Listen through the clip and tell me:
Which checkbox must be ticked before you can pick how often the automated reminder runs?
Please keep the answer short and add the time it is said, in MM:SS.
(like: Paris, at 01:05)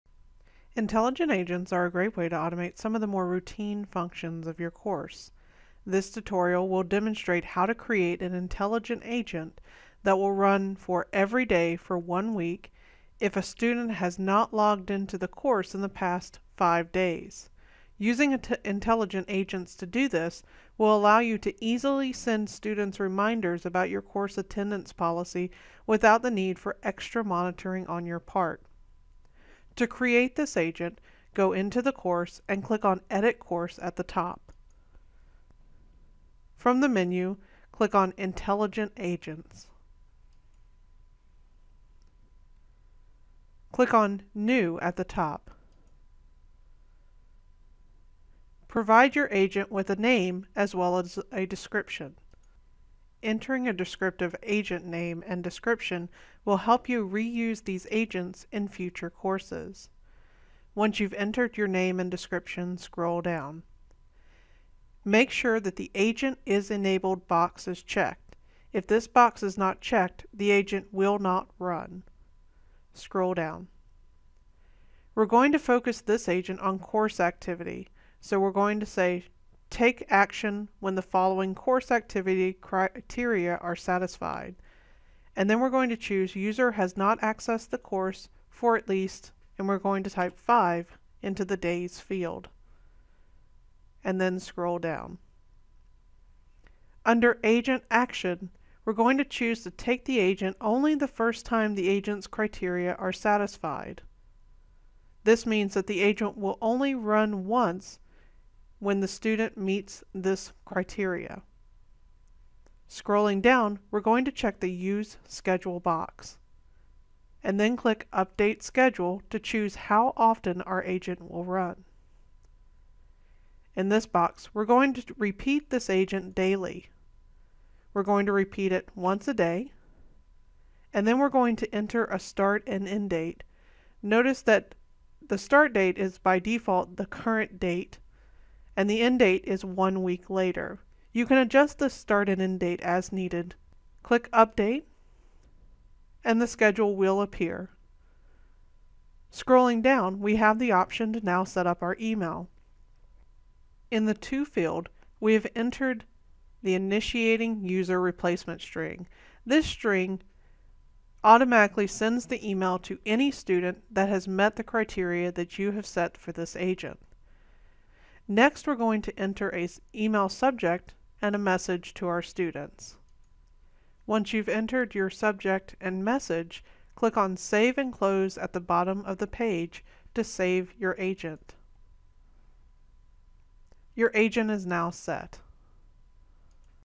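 Use Schedule, at 01:54.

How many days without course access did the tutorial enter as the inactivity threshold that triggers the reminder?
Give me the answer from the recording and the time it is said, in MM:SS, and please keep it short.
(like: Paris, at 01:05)
5, at 01:30.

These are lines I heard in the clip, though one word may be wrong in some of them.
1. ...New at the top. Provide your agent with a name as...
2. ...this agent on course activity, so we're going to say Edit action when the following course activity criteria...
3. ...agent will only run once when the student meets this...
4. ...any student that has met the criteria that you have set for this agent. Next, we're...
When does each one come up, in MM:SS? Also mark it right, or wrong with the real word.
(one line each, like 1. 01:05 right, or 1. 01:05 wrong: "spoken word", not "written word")
1. 00:44 right
2. 01:16 wrong: "Take", not "Edit"
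3. 01:46 right
4. 02:43 right.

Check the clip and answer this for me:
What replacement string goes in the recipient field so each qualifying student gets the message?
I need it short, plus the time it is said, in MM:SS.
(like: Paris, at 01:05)
initiating user, at 02:36.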